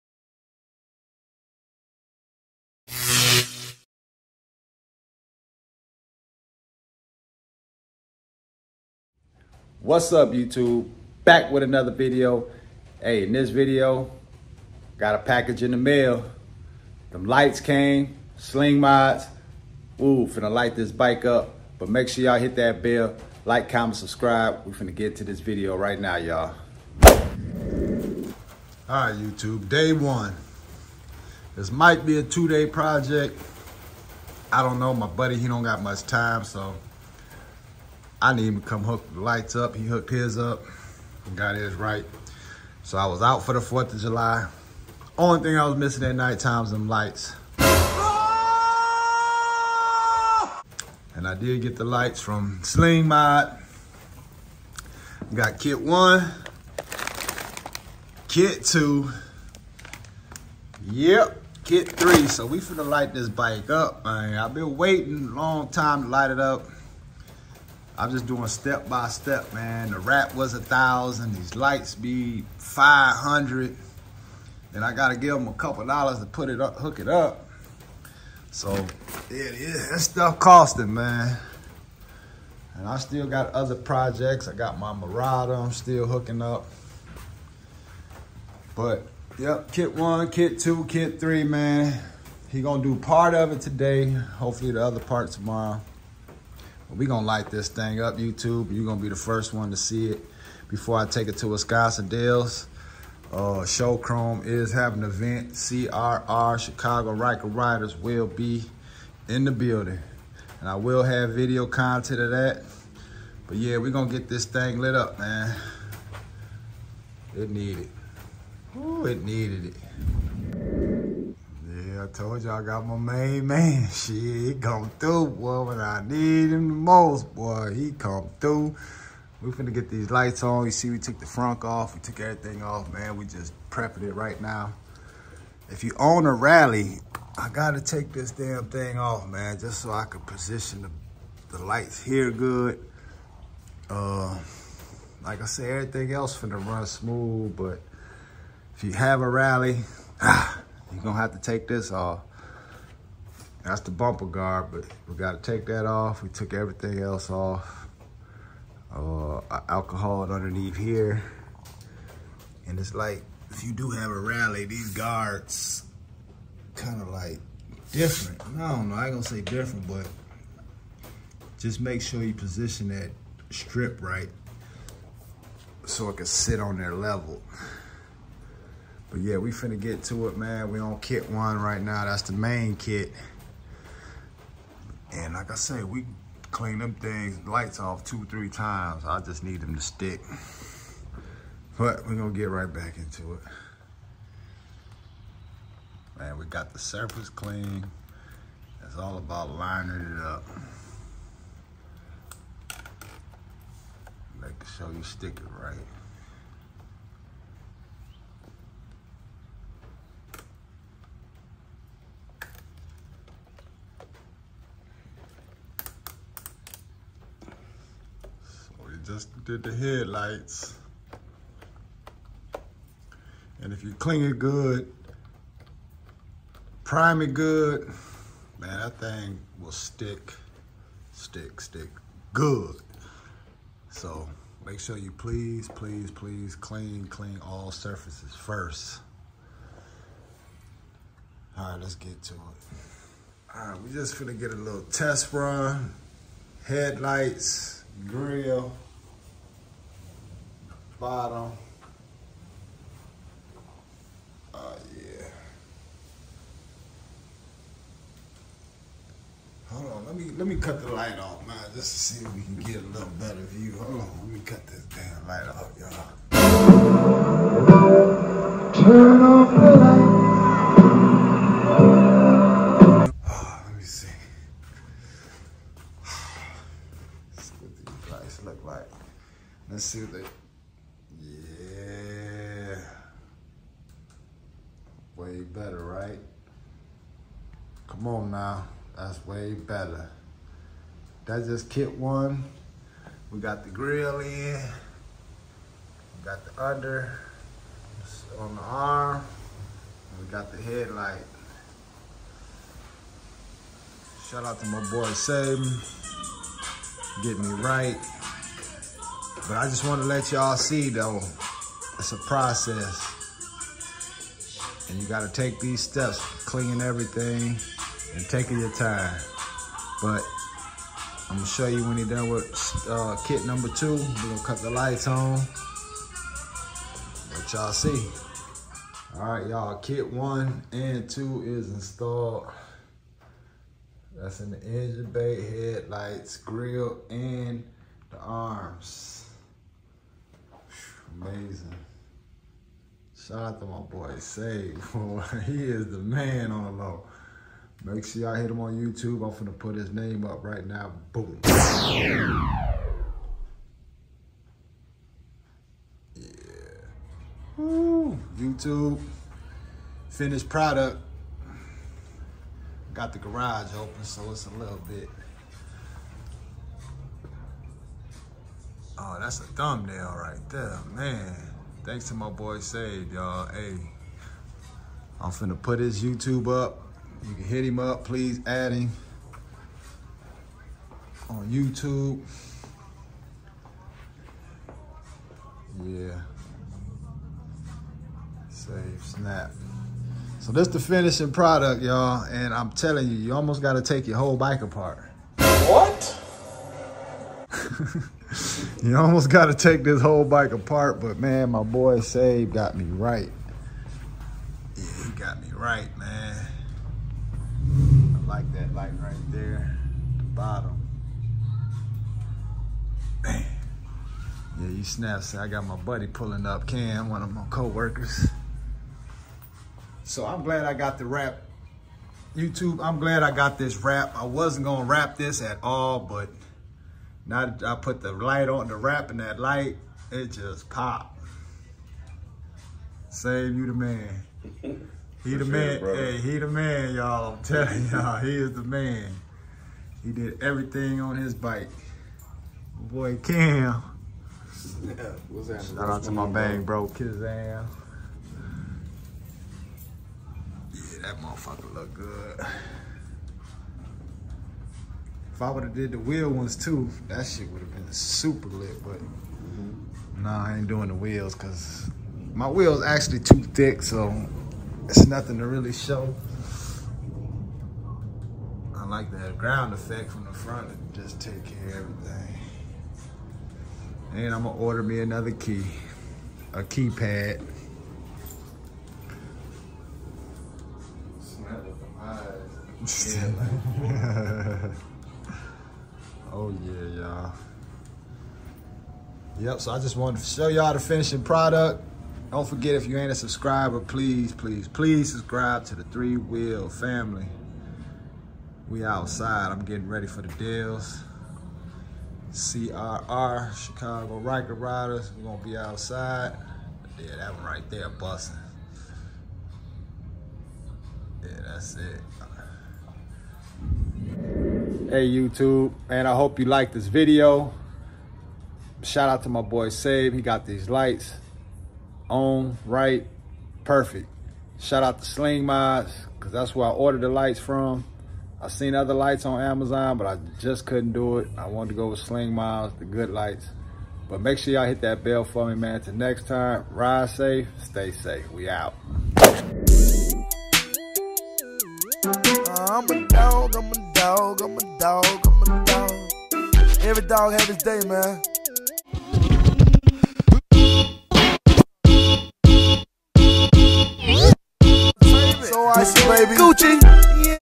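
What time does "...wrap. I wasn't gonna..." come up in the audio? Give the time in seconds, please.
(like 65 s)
423 s.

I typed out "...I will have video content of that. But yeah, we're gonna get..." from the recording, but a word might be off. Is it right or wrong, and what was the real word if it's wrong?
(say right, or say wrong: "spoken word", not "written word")
right.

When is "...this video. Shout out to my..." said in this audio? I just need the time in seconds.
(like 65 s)
516 s.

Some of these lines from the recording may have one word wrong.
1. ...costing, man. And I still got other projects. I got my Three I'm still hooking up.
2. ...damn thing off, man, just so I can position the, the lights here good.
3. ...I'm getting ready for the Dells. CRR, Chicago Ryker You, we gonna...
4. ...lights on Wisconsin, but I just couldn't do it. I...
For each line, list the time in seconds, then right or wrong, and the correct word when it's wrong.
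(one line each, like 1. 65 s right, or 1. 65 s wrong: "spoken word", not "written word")
1. 80 s wrong: "Murata", not "Three"
2. 138 s right
3. 499 s wrong: "Ryders", not "You"
4. 528 s wrong: "Amazon", not "Wisconsin".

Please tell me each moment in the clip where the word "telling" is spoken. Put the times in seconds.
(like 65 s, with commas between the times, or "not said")
392 s, 437 s.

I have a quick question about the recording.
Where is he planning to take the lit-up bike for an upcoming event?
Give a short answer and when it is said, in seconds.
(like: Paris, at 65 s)
Wisconsin Dells, at 101 s.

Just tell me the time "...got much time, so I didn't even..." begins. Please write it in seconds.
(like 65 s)
35 s.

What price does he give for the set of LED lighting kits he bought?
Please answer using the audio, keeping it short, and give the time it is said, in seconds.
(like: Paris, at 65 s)
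500, at 71 s.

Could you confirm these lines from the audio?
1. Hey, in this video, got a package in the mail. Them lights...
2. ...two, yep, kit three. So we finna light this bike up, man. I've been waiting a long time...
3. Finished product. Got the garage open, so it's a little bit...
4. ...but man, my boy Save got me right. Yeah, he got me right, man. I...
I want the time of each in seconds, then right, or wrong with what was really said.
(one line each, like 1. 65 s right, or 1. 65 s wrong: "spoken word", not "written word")
1. 13 s right
2. 58 s right
3. 360 s right
4. 400 s right.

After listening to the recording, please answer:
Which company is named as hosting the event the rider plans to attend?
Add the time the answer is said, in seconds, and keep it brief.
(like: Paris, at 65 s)
Show Chrome, at 103 s.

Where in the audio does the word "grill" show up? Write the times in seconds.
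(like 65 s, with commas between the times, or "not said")
248 s, 293 s, 336 s.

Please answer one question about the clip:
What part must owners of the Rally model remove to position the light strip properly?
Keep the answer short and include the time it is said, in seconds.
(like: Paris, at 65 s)
bumper guard, at 153 s.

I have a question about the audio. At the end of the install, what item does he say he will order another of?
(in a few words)
keypad.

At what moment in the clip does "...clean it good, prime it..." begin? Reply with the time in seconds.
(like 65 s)
223 s.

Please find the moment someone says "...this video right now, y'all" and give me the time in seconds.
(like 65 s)
25 s.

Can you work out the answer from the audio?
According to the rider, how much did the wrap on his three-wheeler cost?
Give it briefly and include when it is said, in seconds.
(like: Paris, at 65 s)
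1000, at 69 s.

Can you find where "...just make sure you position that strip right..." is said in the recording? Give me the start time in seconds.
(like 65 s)
171 s.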